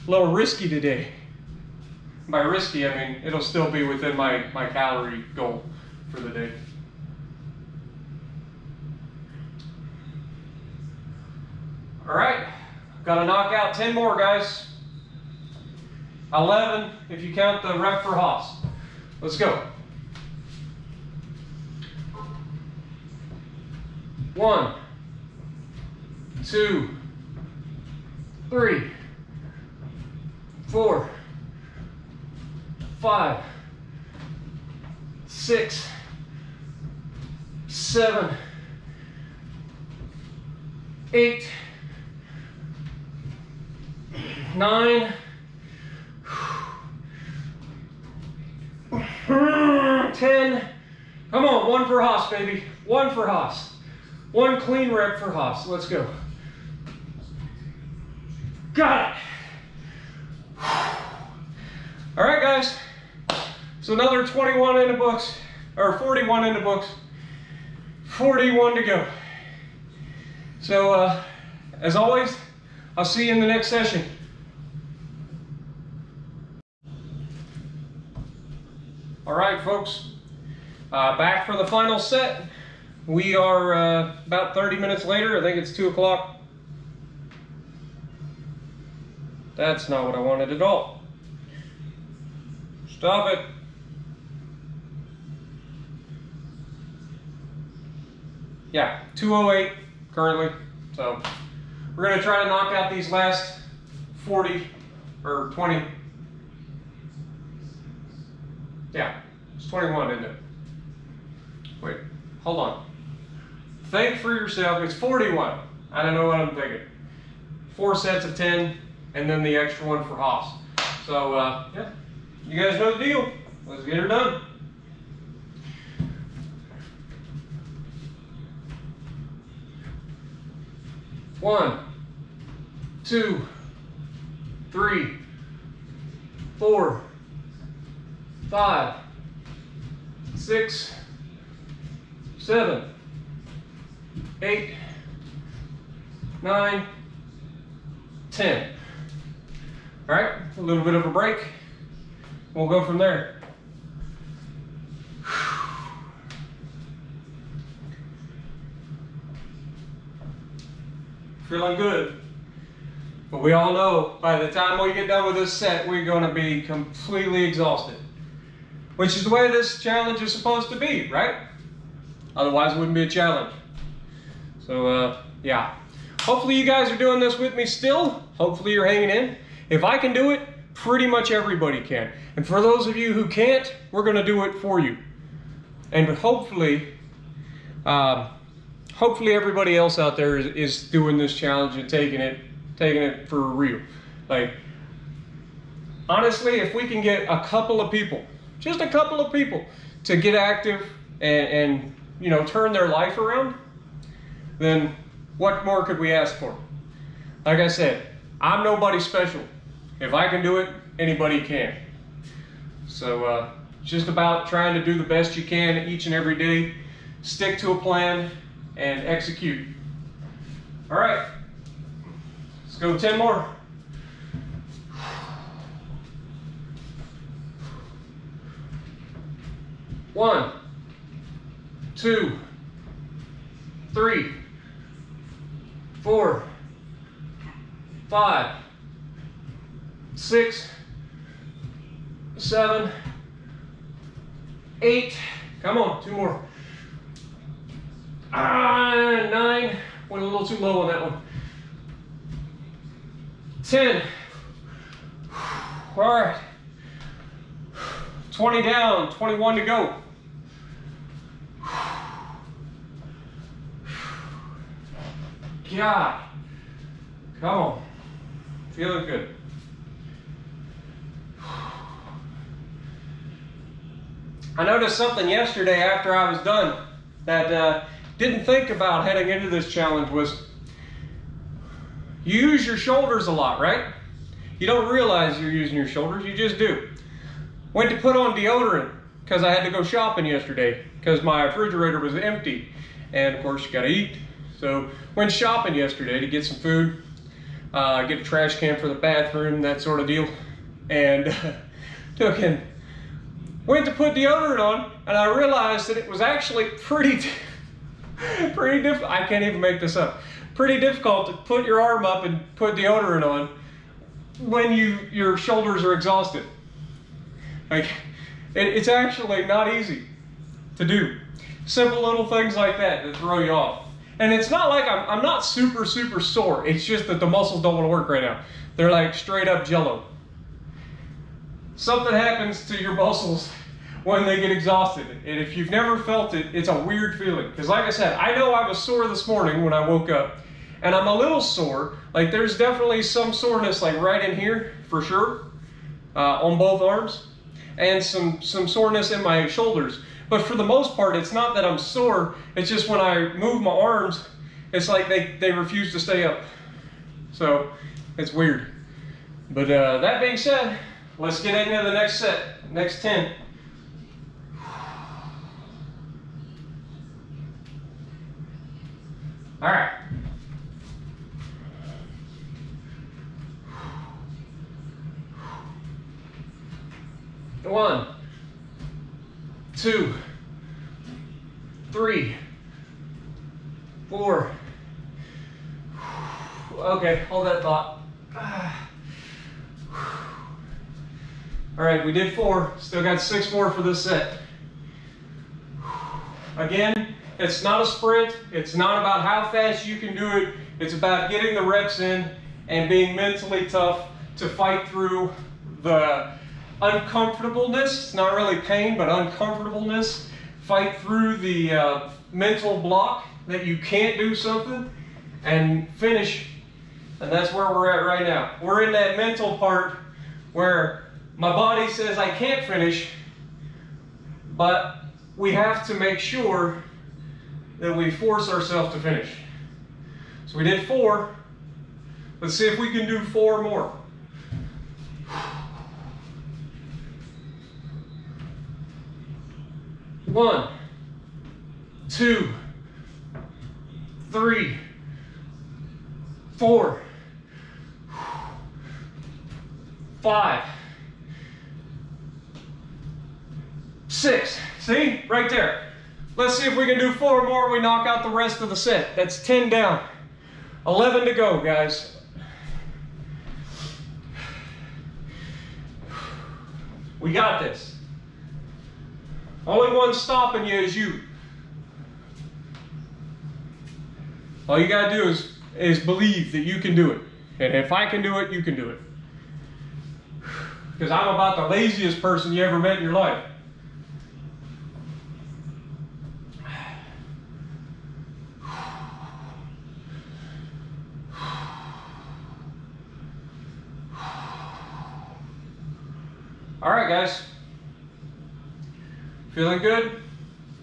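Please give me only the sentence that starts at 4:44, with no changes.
You don't realize you're using your shoulders, you just do.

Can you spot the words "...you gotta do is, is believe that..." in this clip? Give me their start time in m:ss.
7:54.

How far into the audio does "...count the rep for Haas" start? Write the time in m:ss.
0:17.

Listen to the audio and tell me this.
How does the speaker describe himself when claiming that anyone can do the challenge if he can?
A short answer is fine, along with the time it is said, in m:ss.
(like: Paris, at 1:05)
laziest person, at 8:01.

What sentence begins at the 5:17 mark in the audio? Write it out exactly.
Like, it, it's actually not easy to do.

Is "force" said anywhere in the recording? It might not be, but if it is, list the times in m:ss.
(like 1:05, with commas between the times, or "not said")
7:08.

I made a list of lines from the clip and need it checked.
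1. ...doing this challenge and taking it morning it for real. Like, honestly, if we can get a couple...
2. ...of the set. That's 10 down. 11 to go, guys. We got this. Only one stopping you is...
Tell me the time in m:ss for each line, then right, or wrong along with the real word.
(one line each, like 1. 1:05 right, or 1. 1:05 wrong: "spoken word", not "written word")
1. 3:10 wrong: "taking", not "morning"
2. 7:38 right.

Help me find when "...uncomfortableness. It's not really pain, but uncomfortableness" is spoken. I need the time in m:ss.
6:46.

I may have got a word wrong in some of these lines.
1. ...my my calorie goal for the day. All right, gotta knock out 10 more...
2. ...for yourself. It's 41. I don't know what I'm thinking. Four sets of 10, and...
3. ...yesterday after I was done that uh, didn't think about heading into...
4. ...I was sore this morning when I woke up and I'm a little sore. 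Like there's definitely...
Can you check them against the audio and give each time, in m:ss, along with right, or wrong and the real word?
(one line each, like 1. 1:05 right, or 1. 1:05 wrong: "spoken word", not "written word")
1. 0:04 right
2. 1:54 right
3. 4:35 right
4. 5:38 right.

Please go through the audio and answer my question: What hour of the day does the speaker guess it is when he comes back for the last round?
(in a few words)
2 o'clock.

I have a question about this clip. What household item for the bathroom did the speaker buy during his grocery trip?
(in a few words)
trash can.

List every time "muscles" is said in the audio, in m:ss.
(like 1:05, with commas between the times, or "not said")
5:27, 5:32.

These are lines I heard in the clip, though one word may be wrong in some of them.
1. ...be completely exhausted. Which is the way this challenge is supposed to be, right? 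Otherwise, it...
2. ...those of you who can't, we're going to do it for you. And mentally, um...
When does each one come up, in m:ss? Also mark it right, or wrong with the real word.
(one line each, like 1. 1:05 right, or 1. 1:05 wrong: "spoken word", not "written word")
1. 2:46 right
2. 3:02 wrong: "hopefully", not "mentally".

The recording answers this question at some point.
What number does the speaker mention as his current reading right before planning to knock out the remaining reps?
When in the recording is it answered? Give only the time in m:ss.
1:39.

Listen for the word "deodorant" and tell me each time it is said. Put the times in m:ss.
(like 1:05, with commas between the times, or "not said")
4:48, 5:04, 5:12.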